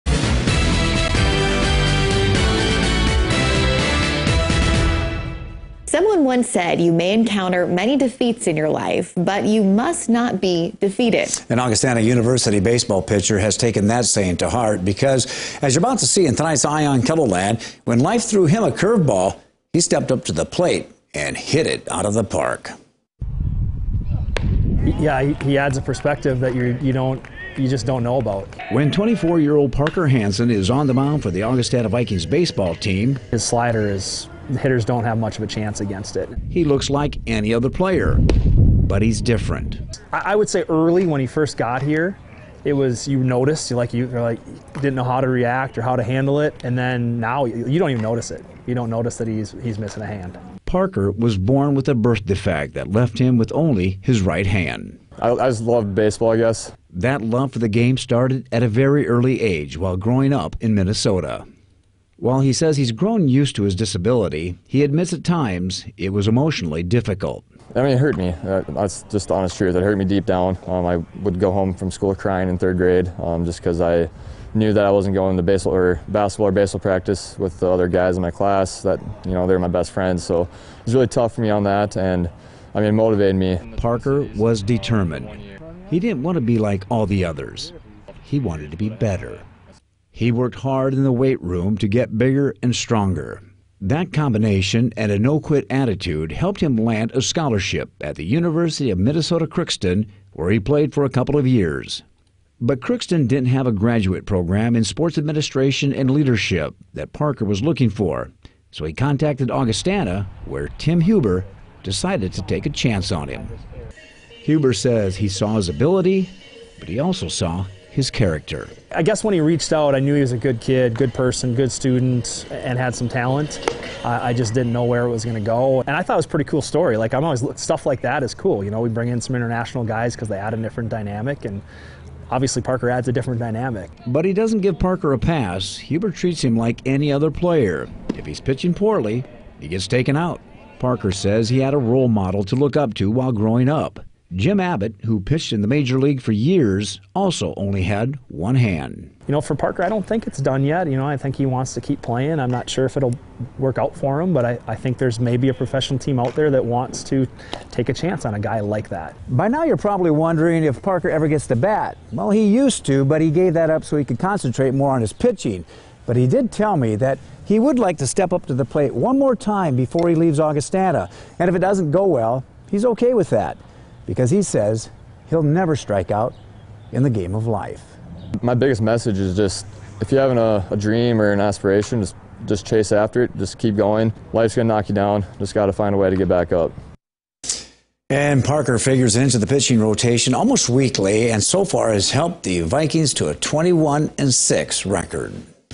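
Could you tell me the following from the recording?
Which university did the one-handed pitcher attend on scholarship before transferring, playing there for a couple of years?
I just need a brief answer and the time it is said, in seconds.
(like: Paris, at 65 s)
University of Minnesota Crookston, at 98 s.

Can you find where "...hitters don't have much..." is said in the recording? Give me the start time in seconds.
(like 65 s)
34 s.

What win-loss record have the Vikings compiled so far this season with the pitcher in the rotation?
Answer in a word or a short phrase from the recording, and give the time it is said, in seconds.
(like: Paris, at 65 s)
21-6, at 193 s.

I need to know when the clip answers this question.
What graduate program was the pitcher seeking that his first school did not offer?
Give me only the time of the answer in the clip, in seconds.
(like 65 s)
104 s.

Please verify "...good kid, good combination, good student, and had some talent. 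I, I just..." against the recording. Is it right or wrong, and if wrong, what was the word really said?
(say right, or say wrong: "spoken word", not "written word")
wrong: "person", not "combination".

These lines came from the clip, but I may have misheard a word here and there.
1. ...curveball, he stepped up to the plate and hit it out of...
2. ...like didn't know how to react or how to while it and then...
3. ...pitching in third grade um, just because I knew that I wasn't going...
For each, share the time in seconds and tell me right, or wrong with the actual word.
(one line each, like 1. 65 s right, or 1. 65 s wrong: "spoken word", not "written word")
1. 18 s right
2. 44 s wrong: "handle", not "while"
3. 72 s wrong: "crying", not "pitching".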